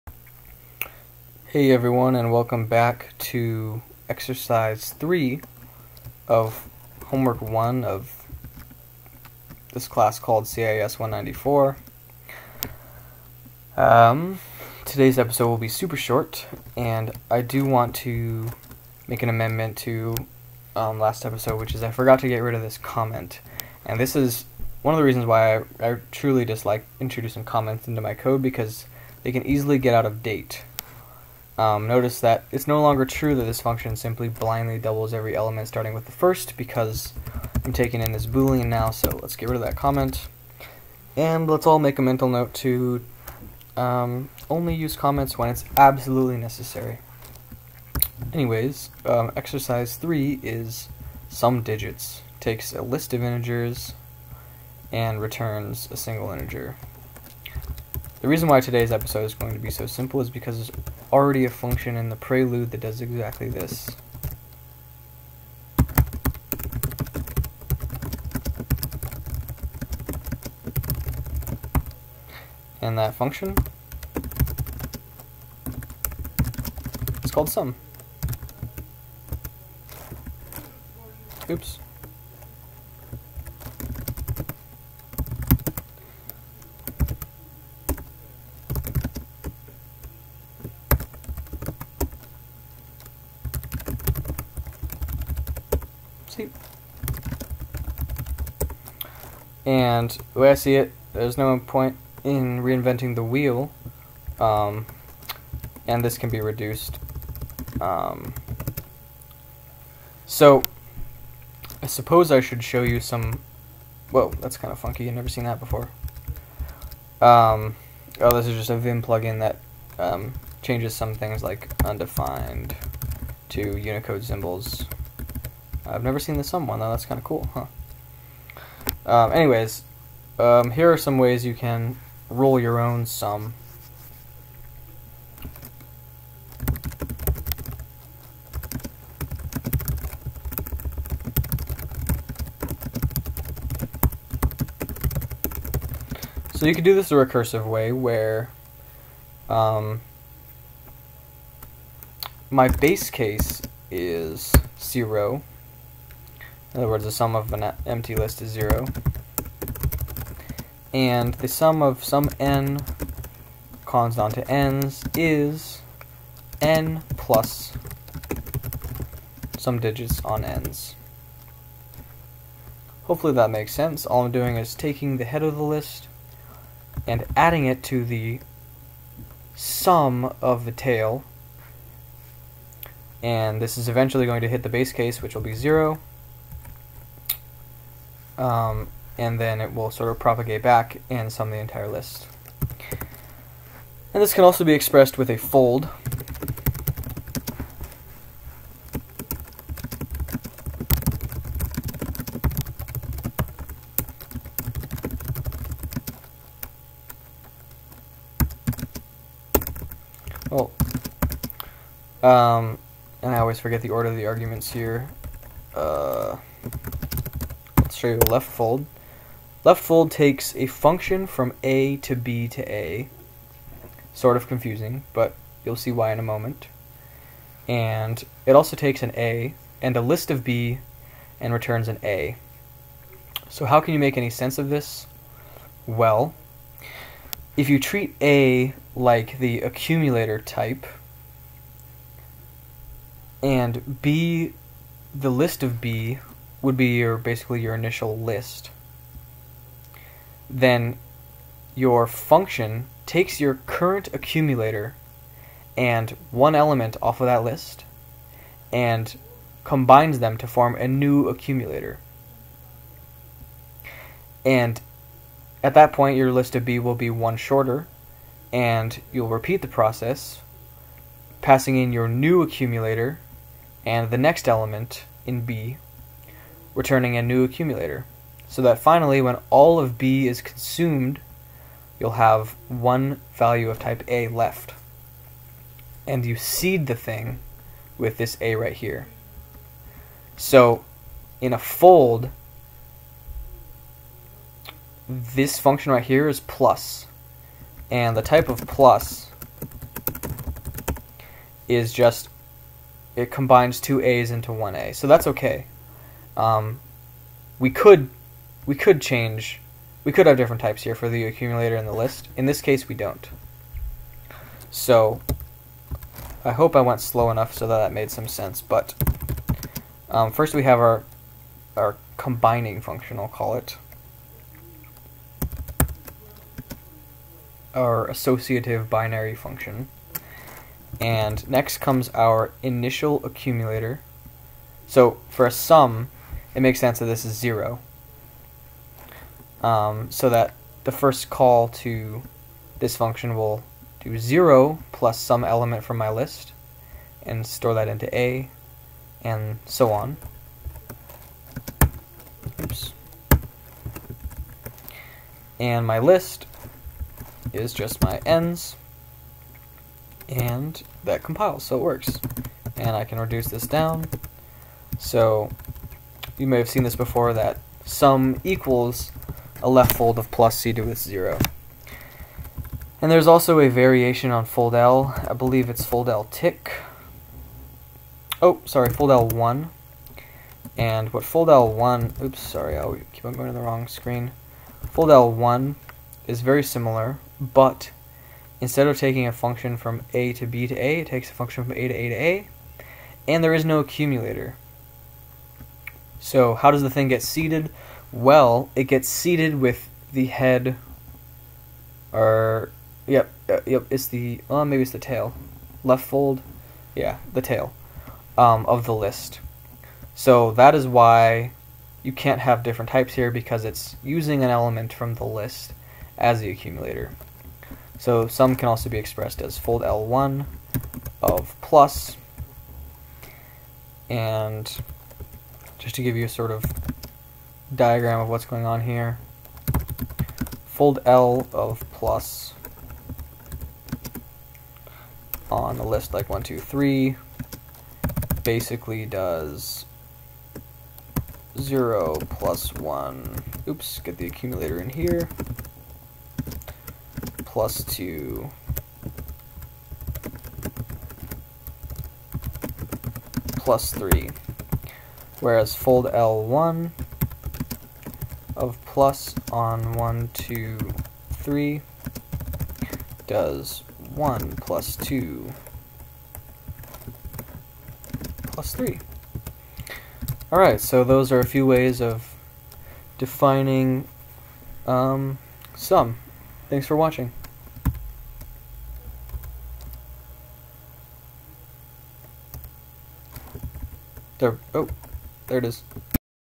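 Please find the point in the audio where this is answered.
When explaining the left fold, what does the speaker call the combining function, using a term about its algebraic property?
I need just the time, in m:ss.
5:28.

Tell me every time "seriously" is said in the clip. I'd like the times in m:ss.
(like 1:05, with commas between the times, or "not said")
not said.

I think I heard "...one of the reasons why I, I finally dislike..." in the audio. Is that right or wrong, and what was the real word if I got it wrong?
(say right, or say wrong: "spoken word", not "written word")
wrong: "truly", not "finally".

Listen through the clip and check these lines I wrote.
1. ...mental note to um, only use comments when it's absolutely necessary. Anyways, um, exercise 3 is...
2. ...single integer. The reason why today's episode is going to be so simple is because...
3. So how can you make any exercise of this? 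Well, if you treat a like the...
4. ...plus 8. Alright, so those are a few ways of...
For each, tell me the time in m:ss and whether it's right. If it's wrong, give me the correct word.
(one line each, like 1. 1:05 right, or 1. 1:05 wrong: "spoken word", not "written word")
1. 0:42 right
2. 0:55 right
3. 3:53 wrong: "sense", not "exercise"
4. 7:48 wrong: "3", not "8".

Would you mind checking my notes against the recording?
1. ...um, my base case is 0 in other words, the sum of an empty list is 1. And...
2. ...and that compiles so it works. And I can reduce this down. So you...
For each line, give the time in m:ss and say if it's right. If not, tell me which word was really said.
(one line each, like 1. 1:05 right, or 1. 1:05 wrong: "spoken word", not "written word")
1. 2:29 wrong: "0", not "1"
2. 6:00 right.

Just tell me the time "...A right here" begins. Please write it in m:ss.
4:48.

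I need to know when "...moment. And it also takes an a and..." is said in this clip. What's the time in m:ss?
3:46.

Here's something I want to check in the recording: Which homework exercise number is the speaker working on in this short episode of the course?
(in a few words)
3.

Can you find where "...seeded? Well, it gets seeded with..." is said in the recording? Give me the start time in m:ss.
6:37.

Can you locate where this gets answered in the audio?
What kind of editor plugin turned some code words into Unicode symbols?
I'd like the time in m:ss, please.
1:58.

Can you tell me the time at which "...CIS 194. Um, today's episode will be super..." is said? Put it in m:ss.
0:10.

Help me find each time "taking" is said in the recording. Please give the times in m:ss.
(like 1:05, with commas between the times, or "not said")
0:37, 2:54, 6:28.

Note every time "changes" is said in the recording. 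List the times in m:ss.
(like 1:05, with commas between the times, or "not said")
2:00, 5:09.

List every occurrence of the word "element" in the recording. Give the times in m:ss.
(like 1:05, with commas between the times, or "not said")
0:35, 4:16, 4:34, 5:45, 6:54.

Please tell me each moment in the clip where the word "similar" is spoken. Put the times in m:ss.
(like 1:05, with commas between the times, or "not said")
6:26.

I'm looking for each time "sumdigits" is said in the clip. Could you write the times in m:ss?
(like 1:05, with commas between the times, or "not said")
0:51, 2:49.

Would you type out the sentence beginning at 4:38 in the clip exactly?
So that finally, when all of B is consumed, you'll have one value of type A left.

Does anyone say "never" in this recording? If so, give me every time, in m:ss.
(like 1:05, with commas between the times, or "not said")
1:55, 2:06.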